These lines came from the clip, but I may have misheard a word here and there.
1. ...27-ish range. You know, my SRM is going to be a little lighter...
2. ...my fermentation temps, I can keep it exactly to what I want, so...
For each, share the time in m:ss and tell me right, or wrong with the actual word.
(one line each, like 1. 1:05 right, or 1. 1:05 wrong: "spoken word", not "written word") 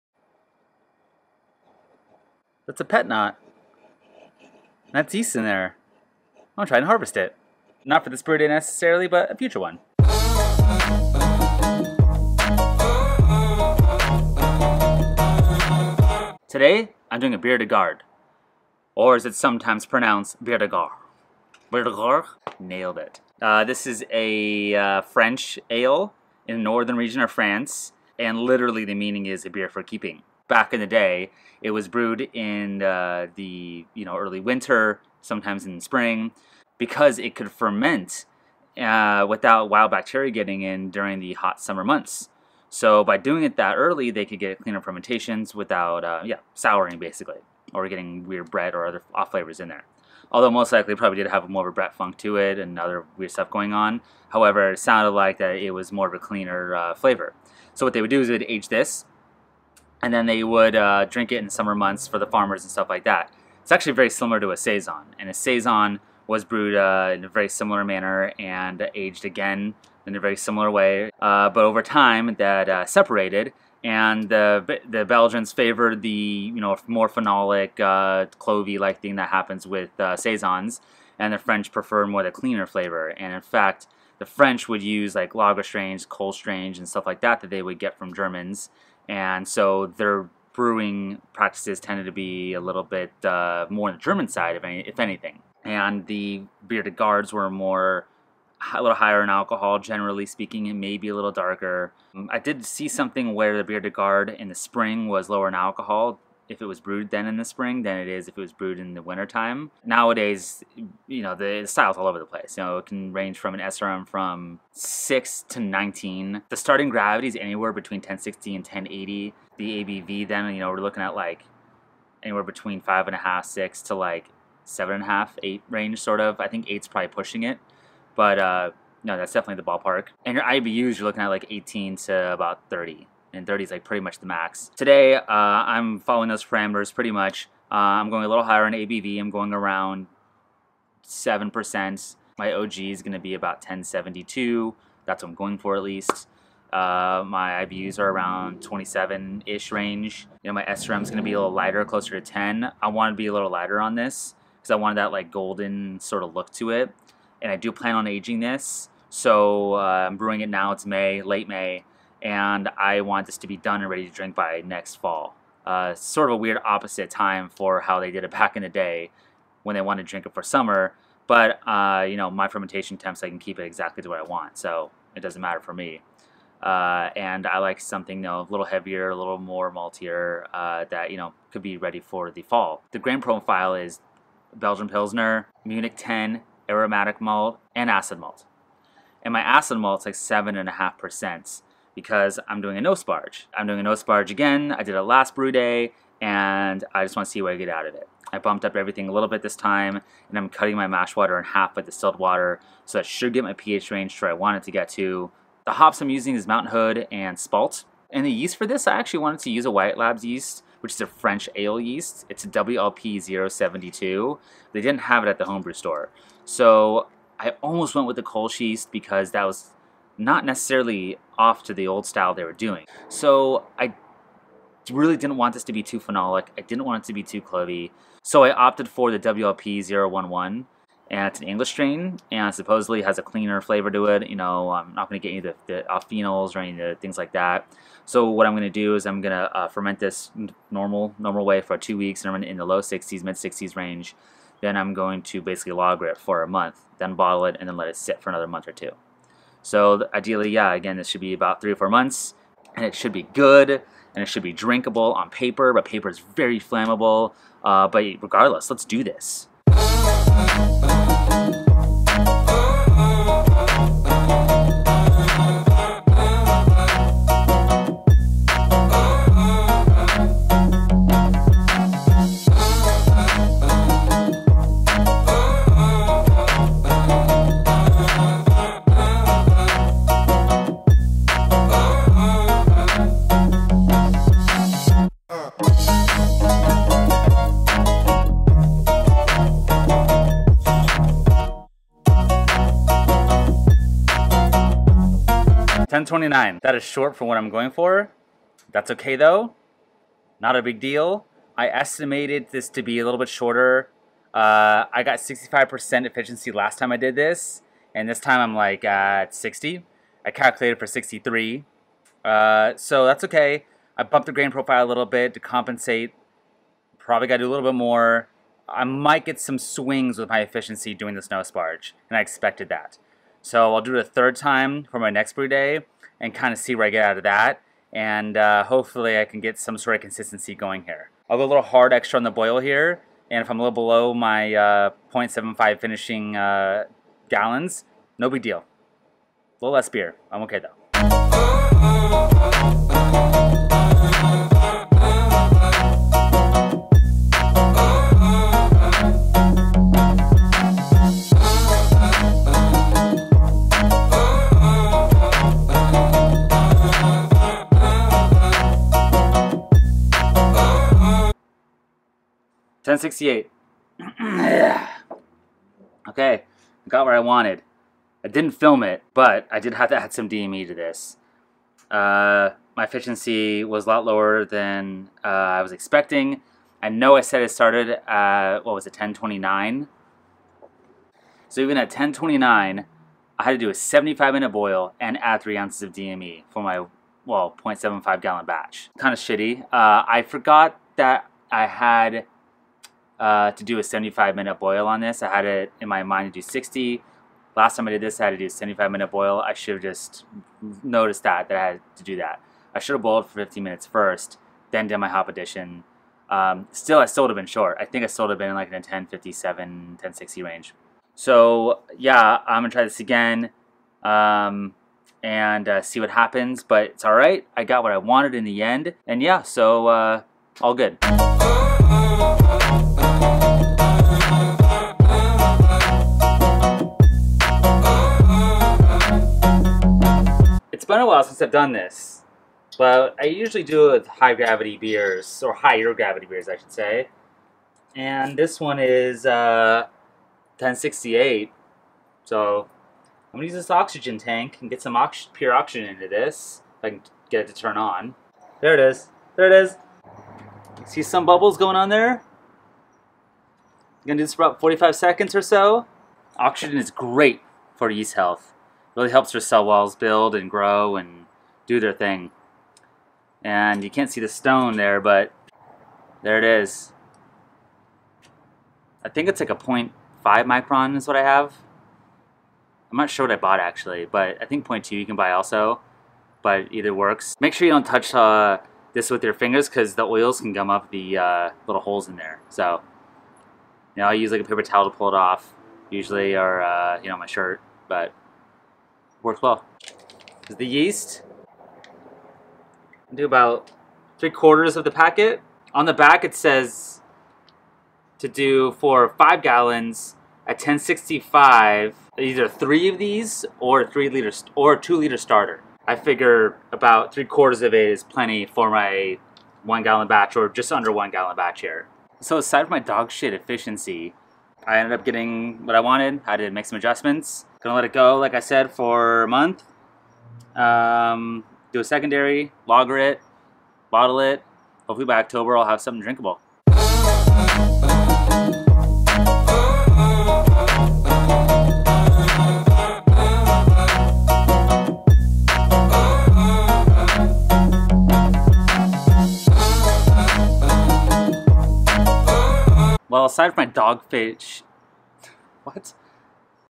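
1. 2:28 right
2. 2:52 right.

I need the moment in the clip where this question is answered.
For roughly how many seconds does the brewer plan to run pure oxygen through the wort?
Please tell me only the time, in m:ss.
7:34.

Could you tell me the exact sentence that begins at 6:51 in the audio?
So yeah, I'm gonna try this again um, and uh, see what happens, but it's all right.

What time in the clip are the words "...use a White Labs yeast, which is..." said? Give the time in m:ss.
3:29.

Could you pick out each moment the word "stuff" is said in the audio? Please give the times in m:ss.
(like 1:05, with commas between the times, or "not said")
0:53, 1:02, 1:26.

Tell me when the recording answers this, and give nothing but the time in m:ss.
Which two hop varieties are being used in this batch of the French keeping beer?
3:26.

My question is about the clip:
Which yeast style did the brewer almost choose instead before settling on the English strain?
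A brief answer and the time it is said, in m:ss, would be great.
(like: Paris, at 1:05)
Kolsch, at 3:38.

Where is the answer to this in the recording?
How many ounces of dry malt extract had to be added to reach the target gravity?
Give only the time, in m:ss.
6:25.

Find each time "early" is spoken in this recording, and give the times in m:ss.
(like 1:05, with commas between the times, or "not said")
0:34, 0:43.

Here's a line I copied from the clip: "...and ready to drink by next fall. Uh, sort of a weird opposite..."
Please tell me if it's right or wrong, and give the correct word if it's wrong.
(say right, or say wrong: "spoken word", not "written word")
right.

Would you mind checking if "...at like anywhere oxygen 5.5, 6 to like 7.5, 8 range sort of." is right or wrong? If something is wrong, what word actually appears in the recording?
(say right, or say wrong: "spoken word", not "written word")
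wrong: "between", not "oxygen".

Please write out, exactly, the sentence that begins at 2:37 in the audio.
And I do plan on aging this.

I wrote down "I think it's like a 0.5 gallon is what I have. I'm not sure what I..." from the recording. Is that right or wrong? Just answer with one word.
wrong.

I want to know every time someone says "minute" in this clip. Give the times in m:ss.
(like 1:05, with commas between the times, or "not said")
6:24, 6:34, 6:38, 6:43.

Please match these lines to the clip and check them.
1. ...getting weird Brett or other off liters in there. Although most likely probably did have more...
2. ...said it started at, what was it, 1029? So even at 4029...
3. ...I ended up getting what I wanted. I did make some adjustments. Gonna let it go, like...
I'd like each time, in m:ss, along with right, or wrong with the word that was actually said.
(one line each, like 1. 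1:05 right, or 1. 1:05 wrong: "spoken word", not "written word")
1. 0:47 wrong: "flavors", not "liters"
2. 6:17 wrong: "1029", not "4029"
3. 8:34 right.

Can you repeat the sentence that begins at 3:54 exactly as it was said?
You know, I'm not going to get any of the, the phenols or any of the things like that.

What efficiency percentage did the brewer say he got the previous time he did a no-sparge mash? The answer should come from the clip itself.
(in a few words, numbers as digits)
65%.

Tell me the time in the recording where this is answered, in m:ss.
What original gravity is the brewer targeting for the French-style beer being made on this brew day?
2:23.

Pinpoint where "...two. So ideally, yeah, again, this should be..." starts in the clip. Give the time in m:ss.
4:08.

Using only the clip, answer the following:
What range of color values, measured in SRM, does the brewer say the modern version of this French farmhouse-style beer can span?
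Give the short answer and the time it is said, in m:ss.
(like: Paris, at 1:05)
6 to 19, at 1:54.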